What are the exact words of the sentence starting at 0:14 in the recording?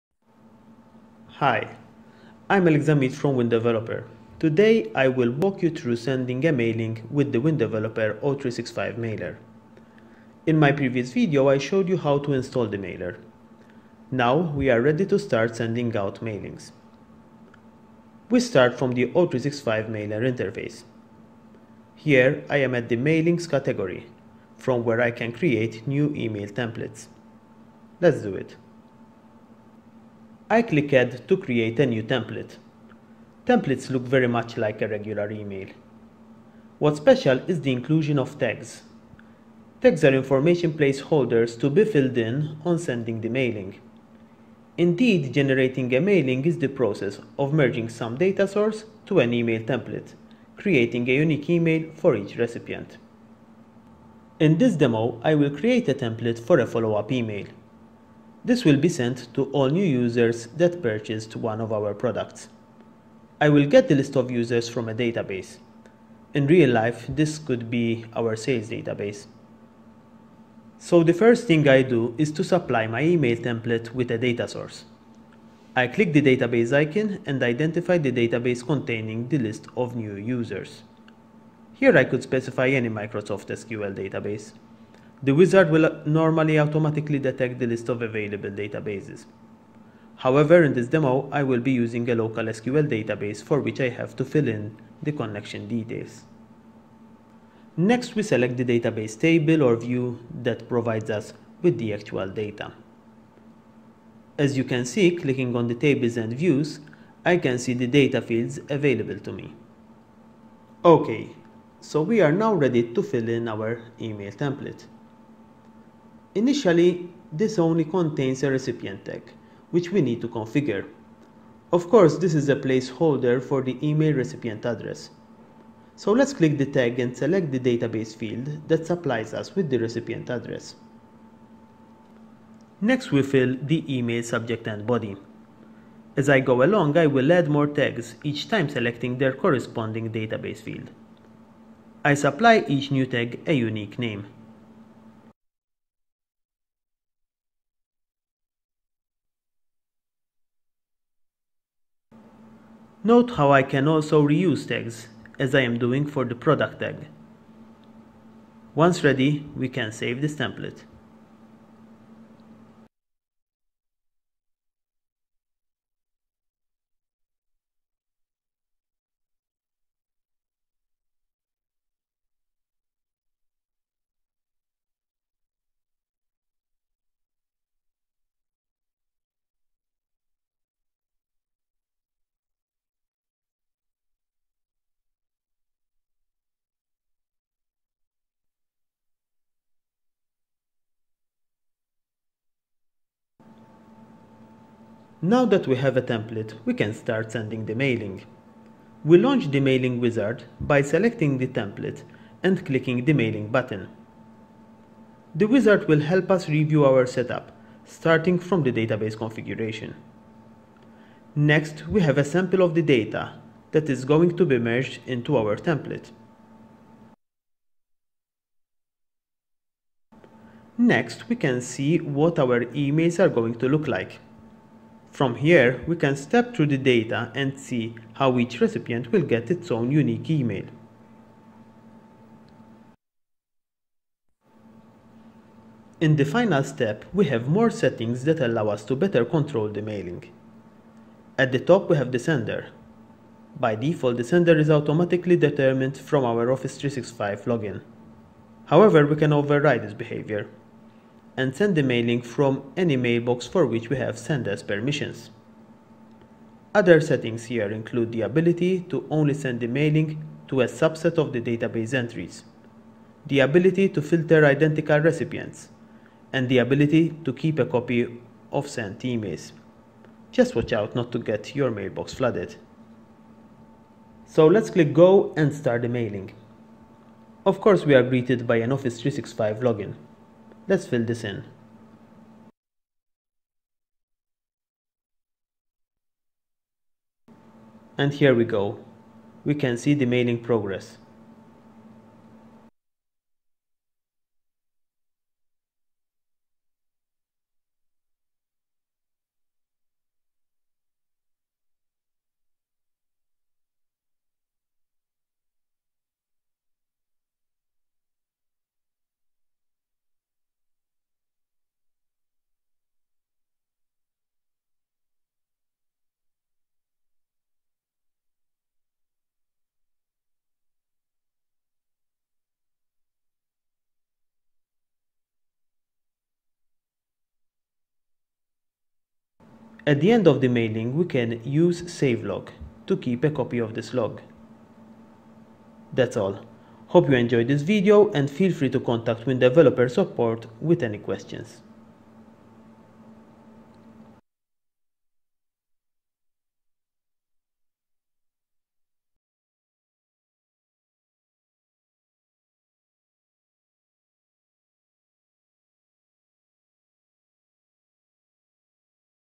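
Now we are ready to start sending out mailings.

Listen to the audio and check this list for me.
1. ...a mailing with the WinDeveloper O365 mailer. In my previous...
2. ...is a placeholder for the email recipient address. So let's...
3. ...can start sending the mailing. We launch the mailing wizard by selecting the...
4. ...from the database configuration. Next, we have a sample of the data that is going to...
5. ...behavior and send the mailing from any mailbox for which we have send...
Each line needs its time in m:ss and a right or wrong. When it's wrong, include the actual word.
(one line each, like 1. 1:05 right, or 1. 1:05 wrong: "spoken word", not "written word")
1. 0:06 right
2. 2:02 right
3. 3:16 right
4. 3:28 right
5. 4:09 right.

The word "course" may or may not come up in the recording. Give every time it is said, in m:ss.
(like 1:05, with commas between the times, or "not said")
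2:01, 4:37.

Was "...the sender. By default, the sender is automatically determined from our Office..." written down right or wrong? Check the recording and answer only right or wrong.
right.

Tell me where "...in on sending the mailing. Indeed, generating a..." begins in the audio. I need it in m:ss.
0:42.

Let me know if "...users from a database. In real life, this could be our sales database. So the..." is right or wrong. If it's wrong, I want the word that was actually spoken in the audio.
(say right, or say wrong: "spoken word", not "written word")
right.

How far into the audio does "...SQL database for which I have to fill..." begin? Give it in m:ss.
1:32.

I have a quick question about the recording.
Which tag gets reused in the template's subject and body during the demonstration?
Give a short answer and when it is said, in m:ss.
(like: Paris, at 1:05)
Product tag, at 2:36.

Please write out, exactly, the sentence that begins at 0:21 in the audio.
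Here I am at the mailings category from where I can create new email templates.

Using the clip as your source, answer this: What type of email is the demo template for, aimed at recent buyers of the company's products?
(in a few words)
Follow-up email.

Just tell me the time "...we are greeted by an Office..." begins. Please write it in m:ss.
4:37.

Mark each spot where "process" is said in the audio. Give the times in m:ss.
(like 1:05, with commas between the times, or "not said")
0:46.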